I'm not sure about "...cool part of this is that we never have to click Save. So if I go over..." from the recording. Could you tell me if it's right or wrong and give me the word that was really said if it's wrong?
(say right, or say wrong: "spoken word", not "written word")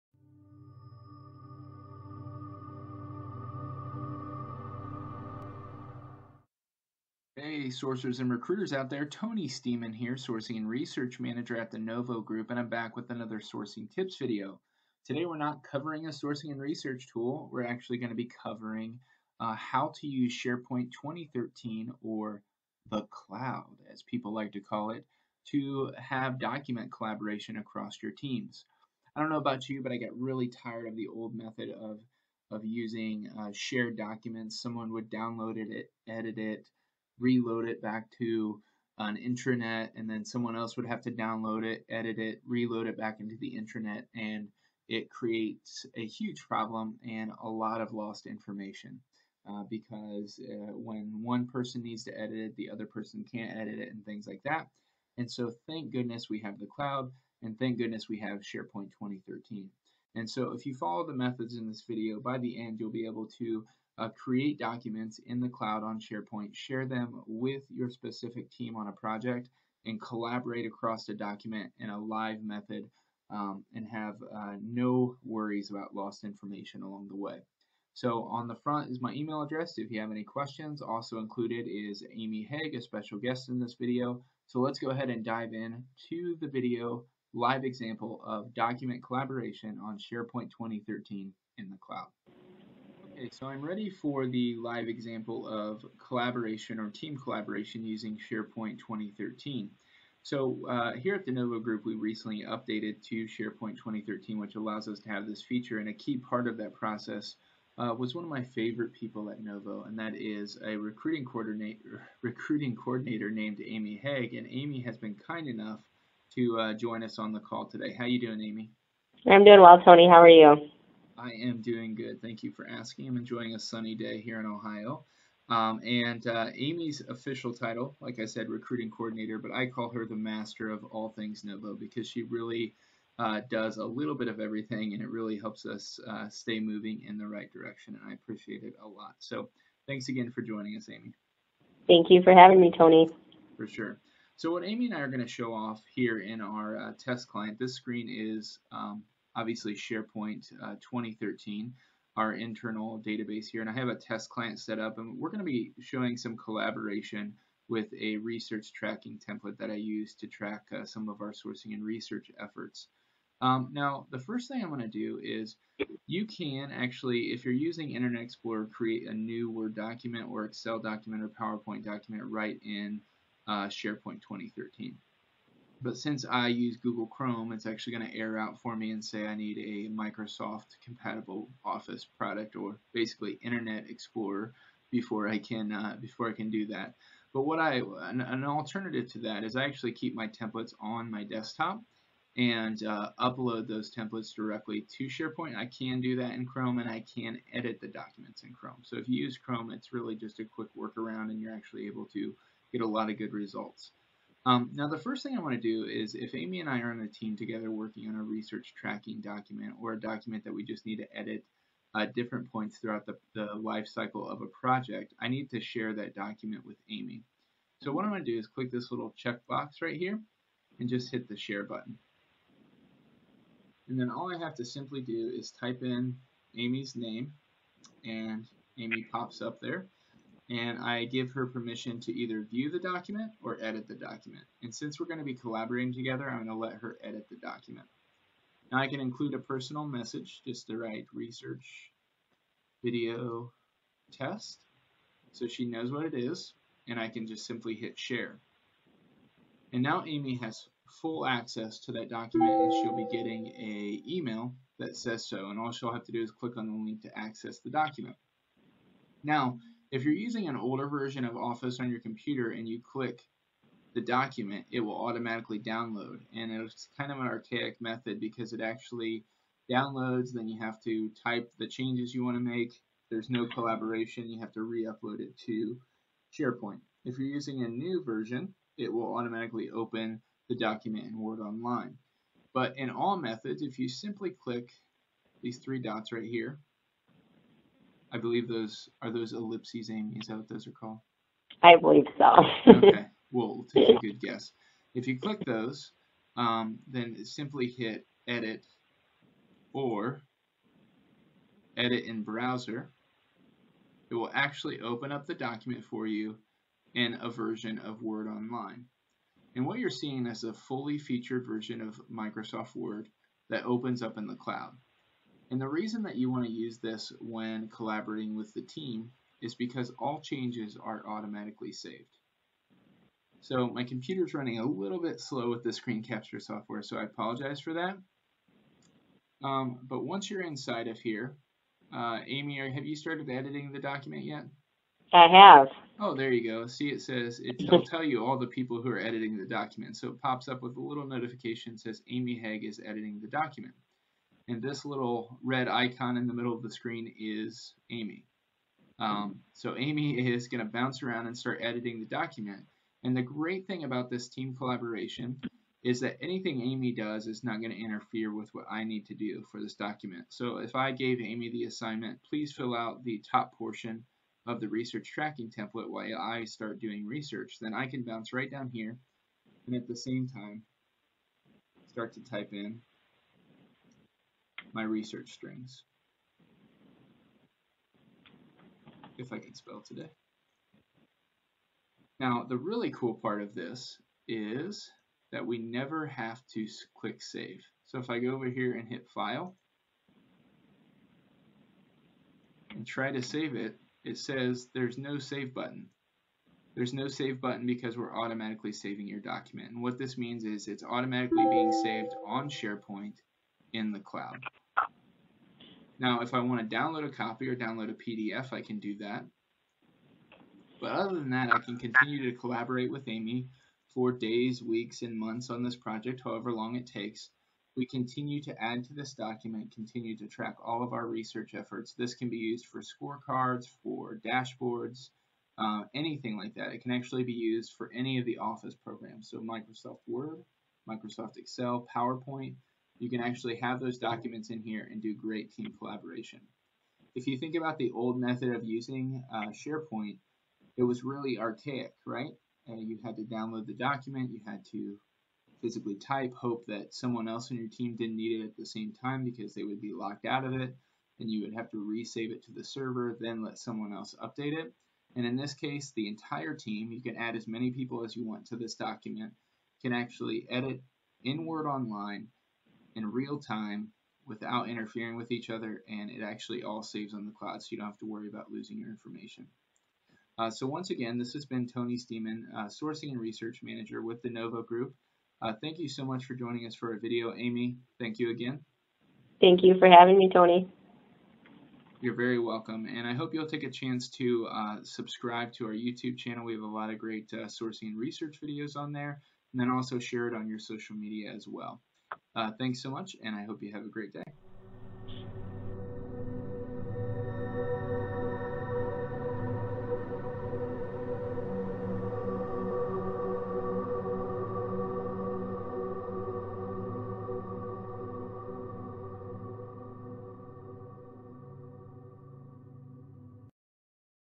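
right.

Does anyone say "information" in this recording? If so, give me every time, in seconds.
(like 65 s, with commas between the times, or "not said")
48 s, 76 s, 468 s.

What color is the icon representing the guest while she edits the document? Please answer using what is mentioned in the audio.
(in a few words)
Red.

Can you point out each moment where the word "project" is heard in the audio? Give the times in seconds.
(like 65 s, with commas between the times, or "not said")
68 s, 214 s, 415 s.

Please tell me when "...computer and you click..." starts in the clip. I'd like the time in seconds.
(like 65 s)
261 s.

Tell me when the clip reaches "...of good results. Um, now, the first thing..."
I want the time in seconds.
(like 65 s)
203 s.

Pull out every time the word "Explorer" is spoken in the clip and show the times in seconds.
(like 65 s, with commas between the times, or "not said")
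168 s, 183 s.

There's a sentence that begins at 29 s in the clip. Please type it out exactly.
I don't know about you, but I get really tired of the old method of, of using uh, shared documents.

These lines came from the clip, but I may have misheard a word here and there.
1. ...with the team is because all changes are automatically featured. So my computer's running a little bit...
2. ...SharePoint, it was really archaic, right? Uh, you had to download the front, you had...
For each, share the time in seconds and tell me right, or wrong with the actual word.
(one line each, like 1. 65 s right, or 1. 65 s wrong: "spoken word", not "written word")
1. 318 s wrong: "saved", not "featured"
2. 439 s wrong: "document", not "front".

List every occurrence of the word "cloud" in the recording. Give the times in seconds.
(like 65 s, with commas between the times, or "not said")
23 s, 56 s, 65 s, 91 s, 314 s, 403 s, 467 s.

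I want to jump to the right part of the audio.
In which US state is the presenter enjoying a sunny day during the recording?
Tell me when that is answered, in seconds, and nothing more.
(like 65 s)
124 s.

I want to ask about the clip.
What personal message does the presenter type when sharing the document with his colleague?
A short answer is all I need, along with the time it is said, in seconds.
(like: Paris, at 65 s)
Research video test, at 241 s.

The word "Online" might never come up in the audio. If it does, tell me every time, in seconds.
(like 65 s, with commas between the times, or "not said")
281 s, 308 s, 461 s.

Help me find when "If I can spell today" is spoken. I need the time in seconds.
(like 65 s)
379 s.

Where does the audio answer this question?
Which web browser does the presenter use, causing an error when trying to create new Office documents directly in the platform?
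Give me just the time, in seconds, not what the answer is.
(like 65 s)
176 s.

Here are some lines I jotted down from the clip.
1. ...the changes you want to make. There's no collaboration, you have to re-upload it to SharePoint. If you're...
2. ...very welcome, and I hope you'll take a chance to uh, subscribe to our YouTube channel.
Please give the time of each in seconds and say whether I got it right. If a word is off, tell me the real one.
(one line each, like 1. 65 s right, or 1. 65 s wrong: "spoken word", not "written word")
1. 271 s right
2. 482 s right.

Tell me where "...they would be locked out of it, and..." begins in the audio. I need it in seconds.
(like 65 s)
449 s.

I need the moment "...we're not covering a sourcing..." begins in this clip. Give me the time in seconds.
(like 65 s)
15 s.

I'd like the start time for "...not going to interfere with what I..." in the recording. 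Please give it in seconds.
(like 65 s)
357 s.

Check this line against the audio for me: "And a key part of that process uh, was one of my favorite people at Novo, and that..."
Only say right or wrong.
right.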